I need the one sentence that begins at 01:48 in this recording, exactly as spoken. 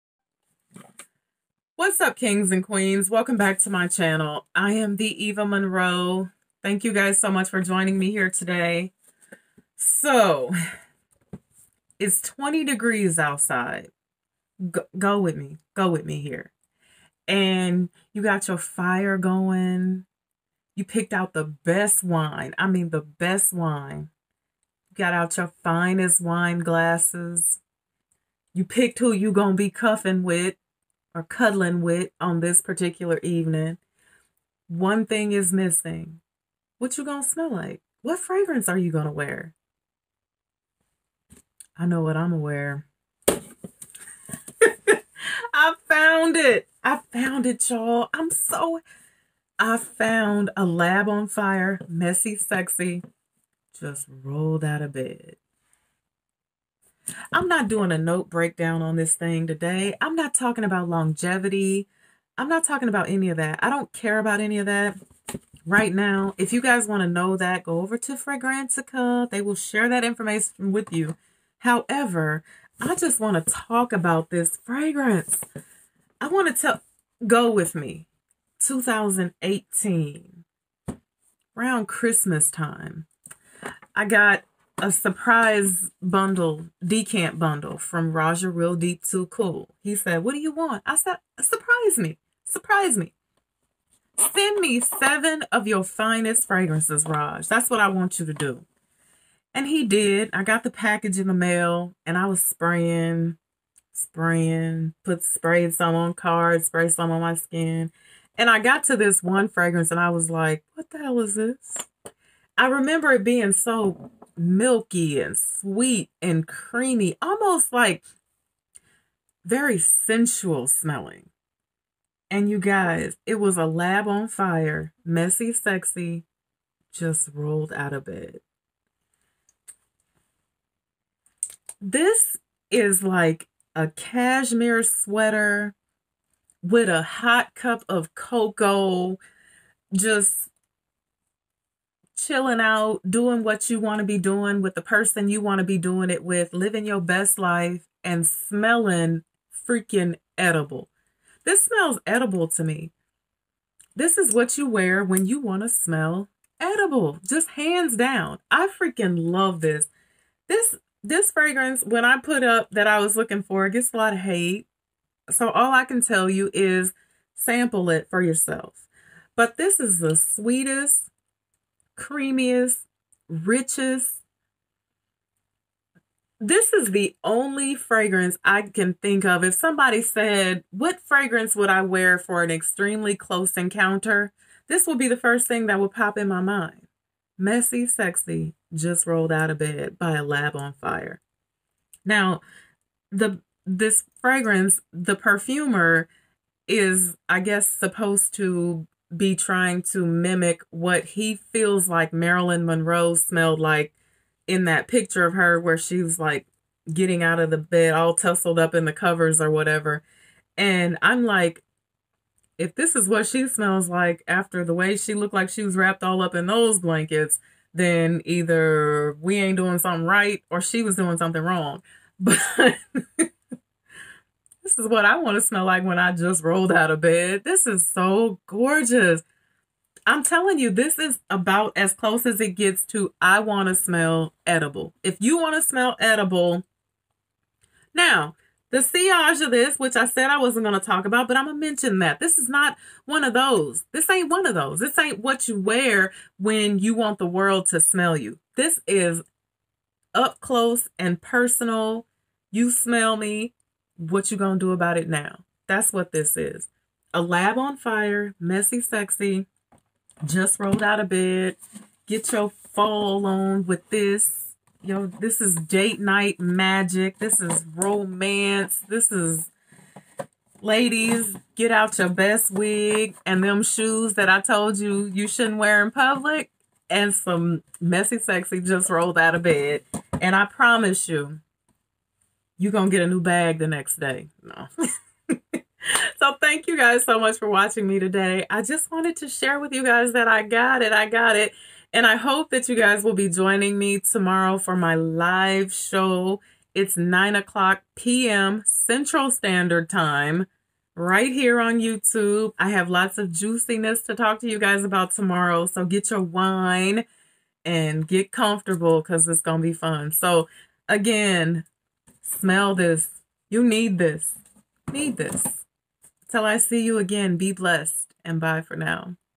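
And I got to this one fragrance and I was like, what the hell is this?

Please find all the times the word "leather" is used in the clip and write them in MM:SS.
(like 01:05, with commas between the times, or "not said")
not said.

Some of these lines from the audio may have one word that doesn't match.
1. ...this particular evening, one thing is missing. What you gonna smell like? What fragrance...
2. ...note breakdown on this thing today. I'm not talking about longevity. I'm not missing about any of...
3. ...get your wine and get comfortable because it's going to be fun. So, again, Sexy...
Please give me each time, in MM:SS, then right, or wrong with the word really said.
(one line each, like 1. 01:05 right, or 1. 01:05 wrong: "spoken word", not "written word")
1. 00:32 right
2. 00:57 wrong: "talking", not "missing"
3. 05:05 wrong: "Smell", not "Sexy".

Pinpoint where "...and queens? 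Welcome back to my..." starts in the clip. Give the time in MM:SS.
00:02.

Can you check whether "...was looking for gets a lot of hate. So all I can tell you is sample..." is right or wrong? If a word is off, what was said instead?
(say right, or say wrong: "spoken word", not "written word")
right.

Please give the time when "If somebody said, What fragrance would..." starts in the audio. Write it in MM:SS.
02:59.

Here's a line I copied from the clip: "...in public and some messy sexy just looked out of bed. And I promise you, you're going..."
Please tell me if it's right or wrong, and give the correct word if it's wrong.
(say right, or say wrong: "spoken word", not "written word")
wrong: "rolled", not "looked".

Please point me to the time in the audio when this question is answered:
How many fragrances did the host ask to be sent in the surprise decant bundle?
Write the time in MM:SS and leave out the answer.
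01:34.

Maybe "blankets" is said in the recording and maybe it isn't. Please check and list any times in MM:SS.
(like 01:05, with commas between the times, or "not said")
03:36.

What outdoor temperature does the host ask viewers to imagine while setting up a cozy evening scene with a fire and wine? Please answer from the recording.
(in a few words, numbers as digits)
20 degrees.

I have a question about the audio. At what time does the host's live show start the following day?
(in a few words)
9 p.m.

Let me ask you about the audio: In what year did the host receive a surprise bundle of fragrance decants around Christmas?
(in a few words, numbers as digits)
2018.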